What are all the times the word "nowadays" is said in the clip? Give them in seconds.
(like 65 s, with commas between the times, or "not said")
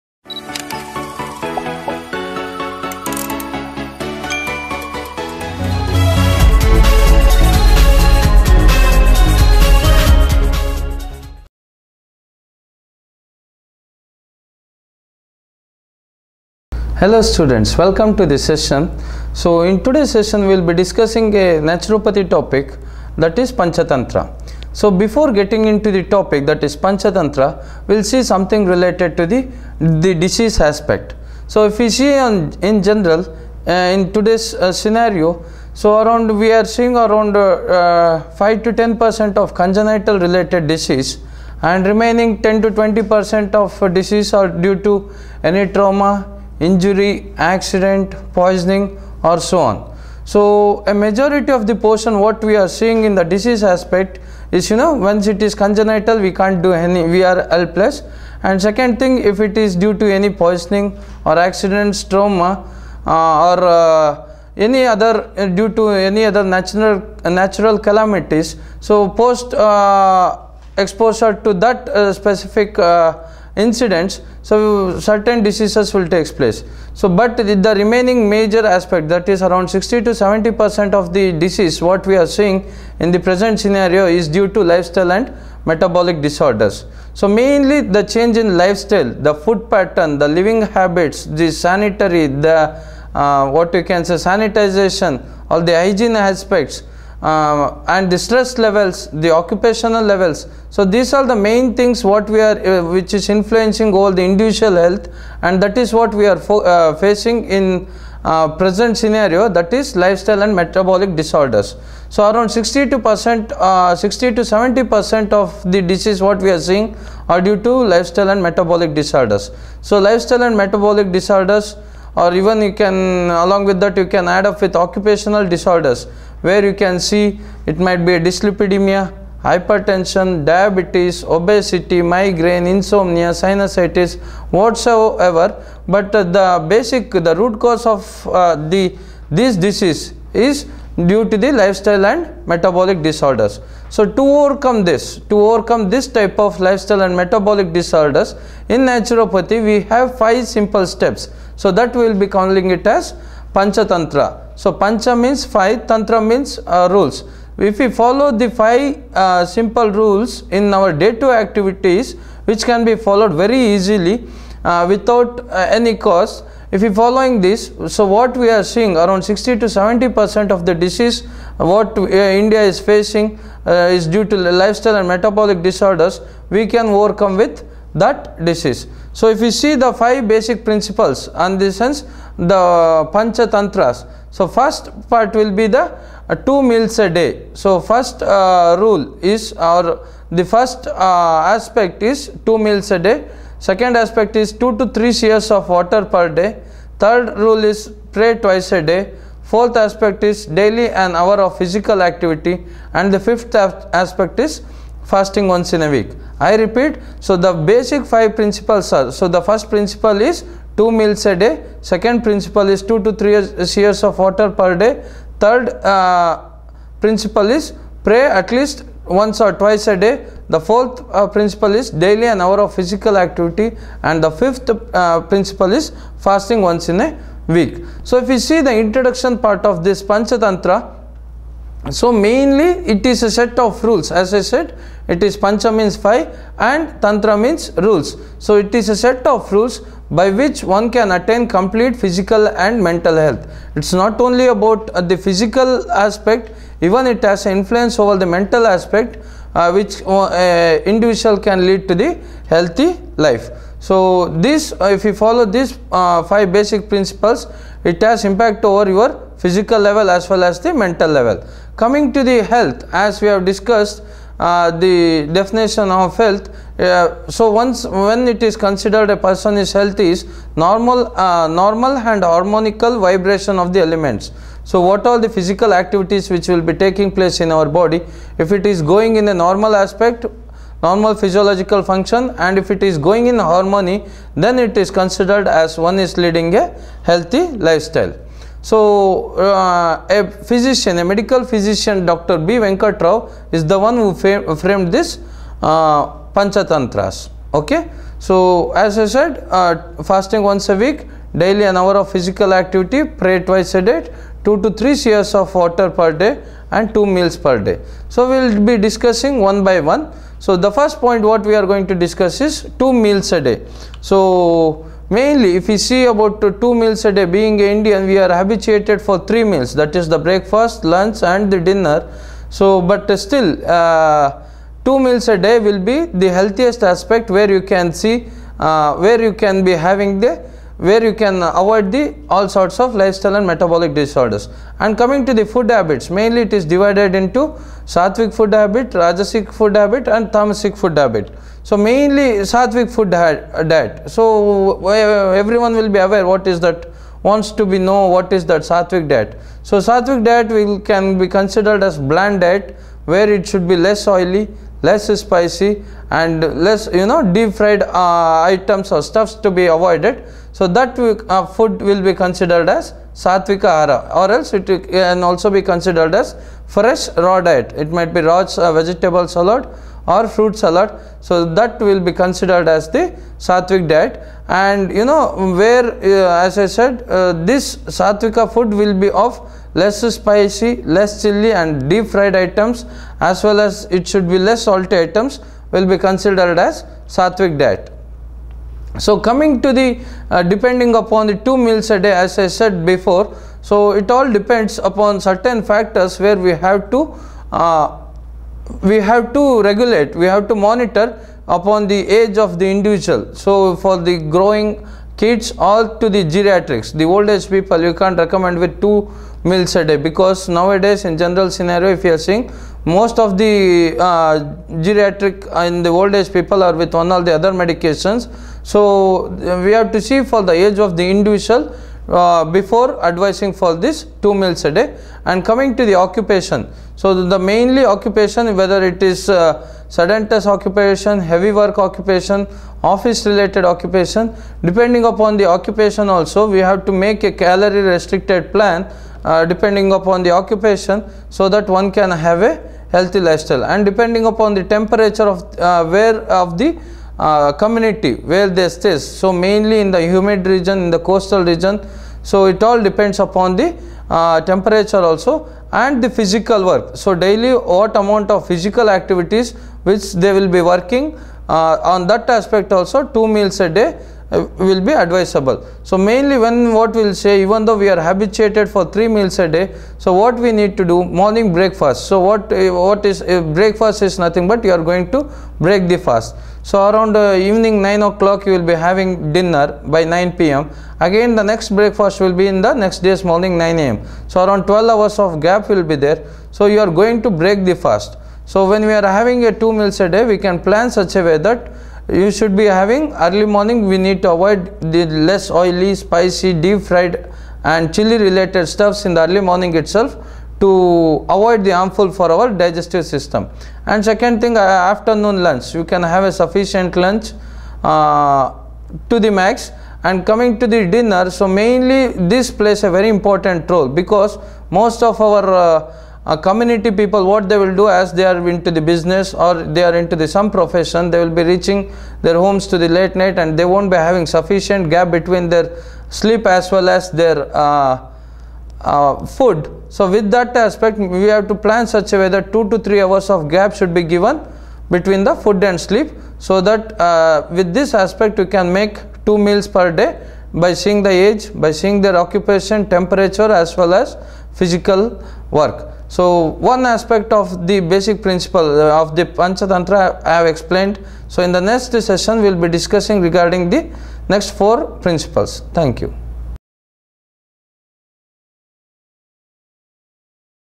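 410 s.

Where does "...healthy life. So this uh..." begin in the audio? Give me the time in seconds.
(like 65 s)
252 s.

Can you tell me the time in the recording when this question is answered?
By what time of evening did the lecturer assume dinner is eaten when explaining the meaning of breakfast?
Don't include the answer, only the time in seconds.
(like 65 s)
480 s.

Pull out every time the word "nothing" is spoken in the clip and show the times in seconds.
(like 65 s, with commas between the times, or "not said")
474 s.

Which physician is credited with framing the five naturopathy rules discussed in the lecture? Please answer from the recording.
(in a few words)
Dr. B. Venkatrao Rao.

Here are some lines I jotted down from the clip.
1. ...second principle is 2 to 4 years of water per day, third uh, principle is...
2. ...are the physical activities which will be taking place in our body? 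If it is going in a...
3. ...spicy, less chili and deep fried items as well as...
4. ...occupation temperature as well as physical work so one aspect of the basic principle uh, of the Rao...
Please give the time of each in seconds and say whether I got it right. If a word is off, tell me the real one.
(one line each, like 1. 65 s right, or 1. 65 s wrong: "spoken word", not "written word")
1. 211 s wrong: "3", not "4"
2. 275 s right
3. 380 s right
4. 542 s wrong: "Panchatantra", not "Rao".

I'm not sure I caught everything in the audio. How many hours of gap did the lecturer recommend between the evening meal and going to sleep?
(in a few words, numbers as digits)
2 to 3 hours.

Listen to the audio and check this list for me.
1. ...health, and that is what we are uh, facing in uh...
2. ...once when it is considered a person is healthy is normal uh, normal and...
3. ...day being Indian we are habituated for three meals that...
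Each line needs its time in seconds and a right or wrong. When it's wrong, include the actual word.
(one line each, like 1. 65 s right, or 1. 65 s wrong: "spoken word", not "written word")
1. 104 s right
2. 267 s right
3. 317 s right.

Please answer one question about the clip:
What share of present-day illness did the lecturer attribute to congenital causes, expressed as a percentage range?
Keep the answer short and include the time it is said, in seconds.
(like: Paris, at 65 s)
5 to 10 percent, at 38 s.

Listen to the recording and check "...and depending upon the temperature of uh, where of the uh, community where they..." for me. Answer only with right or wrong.
right.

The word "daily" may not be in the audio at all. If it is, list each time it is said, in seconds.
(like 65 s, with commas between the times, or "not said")
200 s, 221 s, 301 s, 457 s.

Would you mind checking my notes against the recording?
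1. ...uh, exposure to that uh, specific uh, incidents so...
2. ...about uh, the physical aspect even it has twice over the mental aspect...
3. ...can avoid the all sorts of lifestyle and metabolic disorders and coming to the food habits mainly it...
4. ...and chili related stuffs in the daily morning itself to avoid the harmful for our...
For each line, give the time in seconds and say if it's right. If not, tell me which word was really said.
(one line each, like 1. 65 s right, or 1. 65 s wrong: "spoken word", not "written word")
1. 69 s right
2. 244 s wrong: "influence", not "twice"
3. 331 s right
4. 497 s wrong: "early", not "daily".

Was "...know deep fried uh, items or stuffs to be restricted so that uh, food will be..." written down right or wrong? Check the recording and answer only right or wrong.
wrong.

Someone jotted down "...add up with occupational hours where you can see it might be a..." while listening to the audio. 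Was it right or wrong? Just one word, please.
wrong.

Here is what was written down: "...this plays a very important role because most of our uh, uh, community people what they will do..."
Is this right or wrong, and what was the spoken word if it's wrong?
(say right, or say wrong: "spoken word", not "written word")
right.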